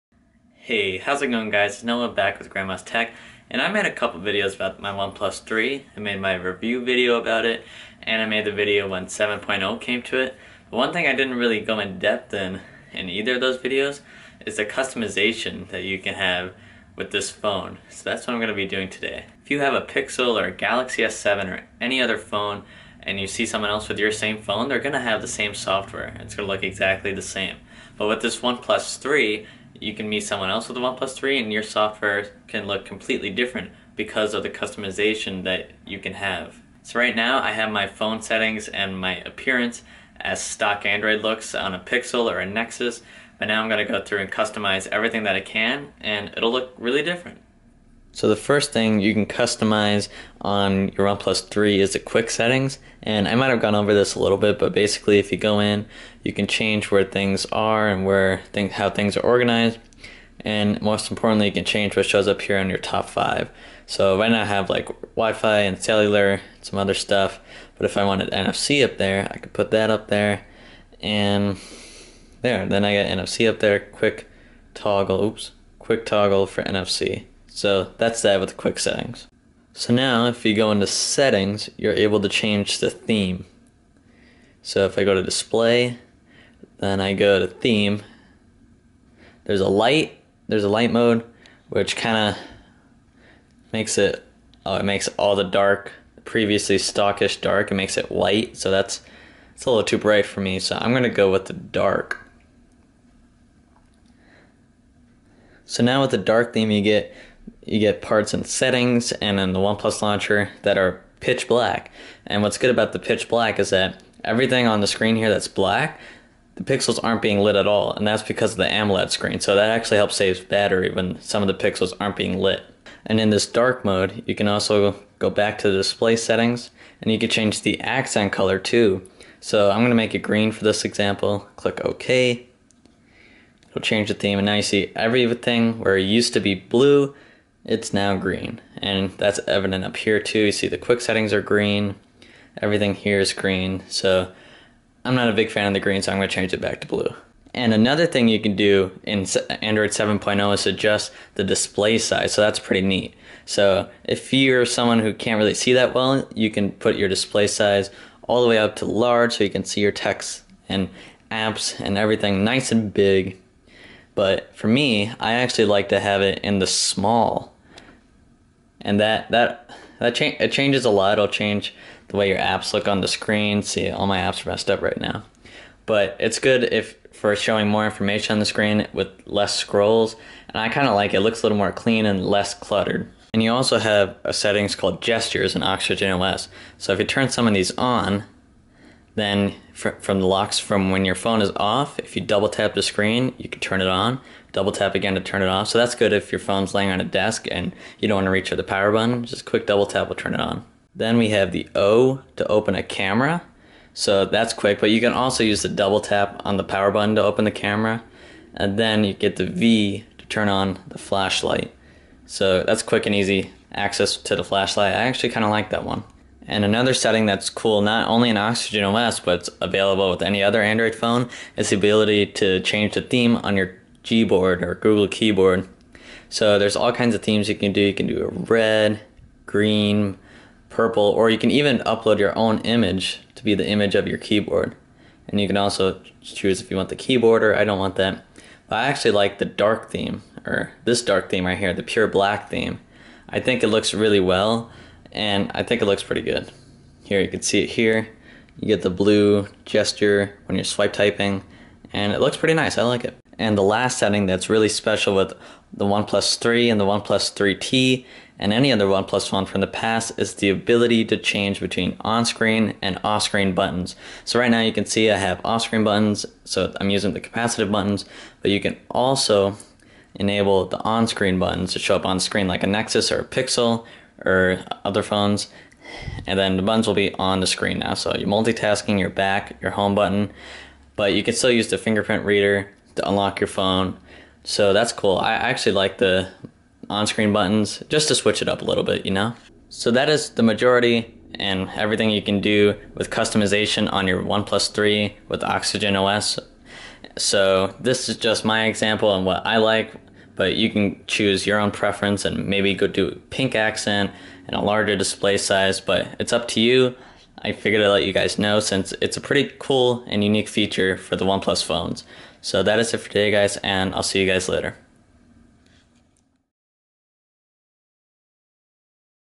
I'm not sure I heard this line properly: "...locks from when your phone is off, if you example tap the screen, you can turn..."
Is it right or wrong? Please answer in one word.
wrong.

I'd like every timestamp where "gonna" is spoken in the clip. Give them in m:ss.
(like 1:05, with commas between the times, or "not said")
0:43, 2:26.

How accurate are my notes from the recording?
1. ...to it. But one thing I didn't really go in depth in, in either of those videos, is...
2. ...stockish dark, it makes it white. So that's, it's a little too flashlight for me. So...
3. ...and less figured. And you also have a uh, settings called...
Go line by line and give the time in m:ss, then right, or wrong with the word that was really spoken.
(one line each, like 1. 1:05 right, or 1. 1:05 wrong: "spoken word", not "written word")
1. 0:10 right
2. 1:36 wrong: "bright", not "flashlight"
3. 3:02 wrong: "cluttered", not "figured".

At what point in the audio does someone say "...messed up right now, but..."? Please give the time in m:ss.
2:54.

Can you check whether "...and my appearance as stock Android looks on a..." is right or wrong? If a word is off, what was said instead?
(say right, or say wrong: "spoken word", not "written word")
right.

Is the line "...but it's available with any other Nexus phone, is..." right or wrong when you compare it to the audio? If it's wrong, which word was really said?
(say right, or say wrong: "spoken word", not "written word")
wrong: "Android", not "Nexus".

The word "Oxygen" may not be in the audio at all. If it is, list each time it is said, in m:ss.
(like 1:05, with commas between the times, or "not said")
3:05, 3:38, 4:55.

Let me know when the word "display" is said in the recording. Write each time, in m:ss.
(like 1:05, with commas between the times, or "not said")
1:25, 2:05, 2:31, 2:37, 5:04.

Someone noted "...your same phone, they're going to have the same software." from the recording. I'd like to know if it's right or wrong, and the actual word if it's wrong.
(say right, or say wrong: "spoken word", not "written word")
right.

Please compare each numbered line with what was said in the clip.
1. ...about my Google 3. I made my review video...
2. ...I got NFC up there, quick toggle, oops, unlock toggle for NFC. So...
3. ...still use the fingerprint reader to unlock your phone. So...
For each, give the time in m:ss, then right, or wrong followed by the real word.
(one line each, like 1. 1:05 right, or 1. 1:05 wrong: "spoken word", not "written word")
1. 0:04 wrong: "OnePlus", not "Google"
2. 1:12 wrong: "quick", not "unlock"
3. 4:41 right.